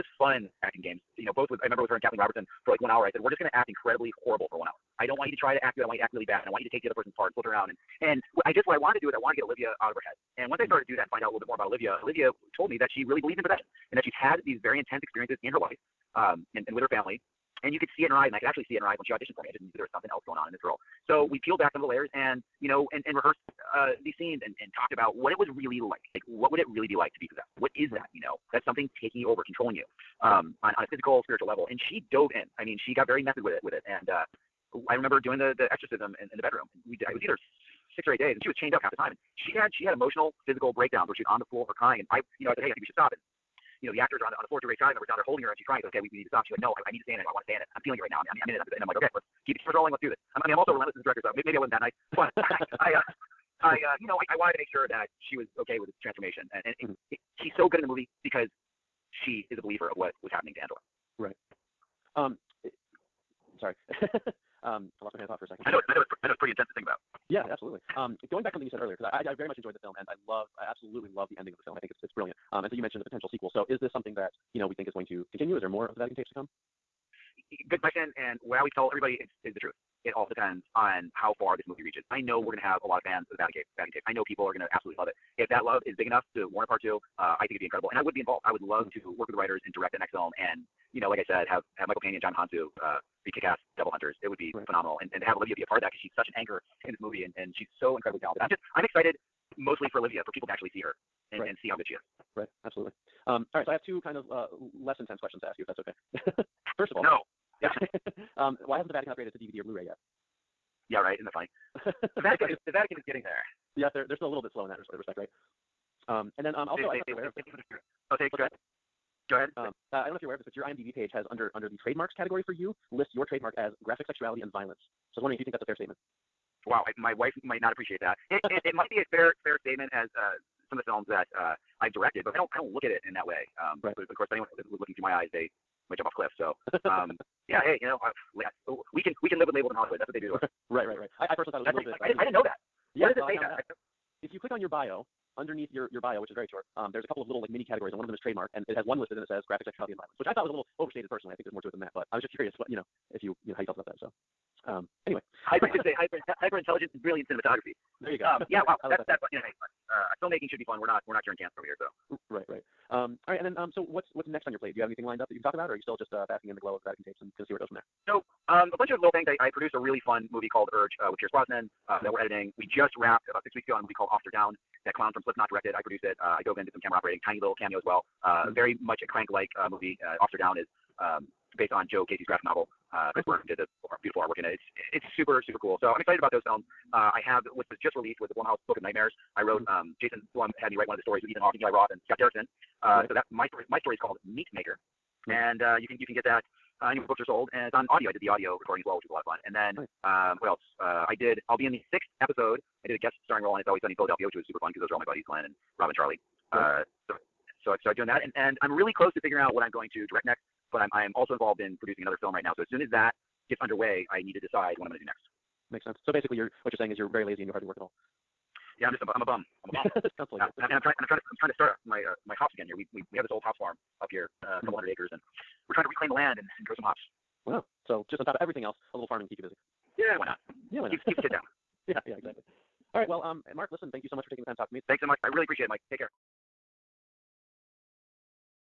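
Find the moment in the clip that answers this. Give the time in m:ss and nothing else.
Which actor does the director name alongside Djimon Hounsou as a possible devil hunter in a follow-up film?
1:31.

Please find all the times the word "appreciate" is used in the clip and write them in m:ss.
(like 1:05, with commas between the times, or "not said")
2:07, 3:55.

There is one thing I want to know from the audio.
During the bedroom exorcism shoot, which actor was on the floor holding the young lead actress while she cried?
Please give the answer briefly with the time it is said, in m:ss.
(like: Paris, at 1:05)
Dougray Scott, at 0:44.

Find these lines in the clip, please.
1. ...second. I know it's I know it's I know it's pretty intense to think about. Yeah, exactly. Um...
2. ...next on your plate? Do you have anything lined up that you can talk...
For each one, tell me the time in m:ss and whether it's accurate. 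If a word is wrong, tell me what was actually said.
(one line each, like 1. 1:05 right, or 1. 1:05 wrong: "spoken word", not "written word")
1. 1:05 wrong: "absolutely", not "exactly"
2. 2:44 right.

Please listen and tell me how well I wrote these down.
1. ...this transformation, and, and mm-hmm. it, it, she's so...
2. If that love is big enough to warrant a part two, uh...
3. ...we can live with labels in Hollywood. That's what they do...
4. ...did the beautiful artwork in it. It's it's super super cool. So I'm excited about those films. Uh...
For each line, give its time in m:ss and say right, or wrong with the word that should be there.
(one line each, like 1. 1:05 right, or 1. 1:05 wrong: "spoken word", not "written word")
1. 0:55 right
2. 1:25 right
3. 2:19 right
4. 3:03 right.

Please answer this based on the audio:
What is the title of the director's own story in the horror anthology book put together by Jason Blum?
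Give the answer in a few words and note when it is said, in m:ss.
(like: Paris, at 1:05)
Meat Maker, at 3:14.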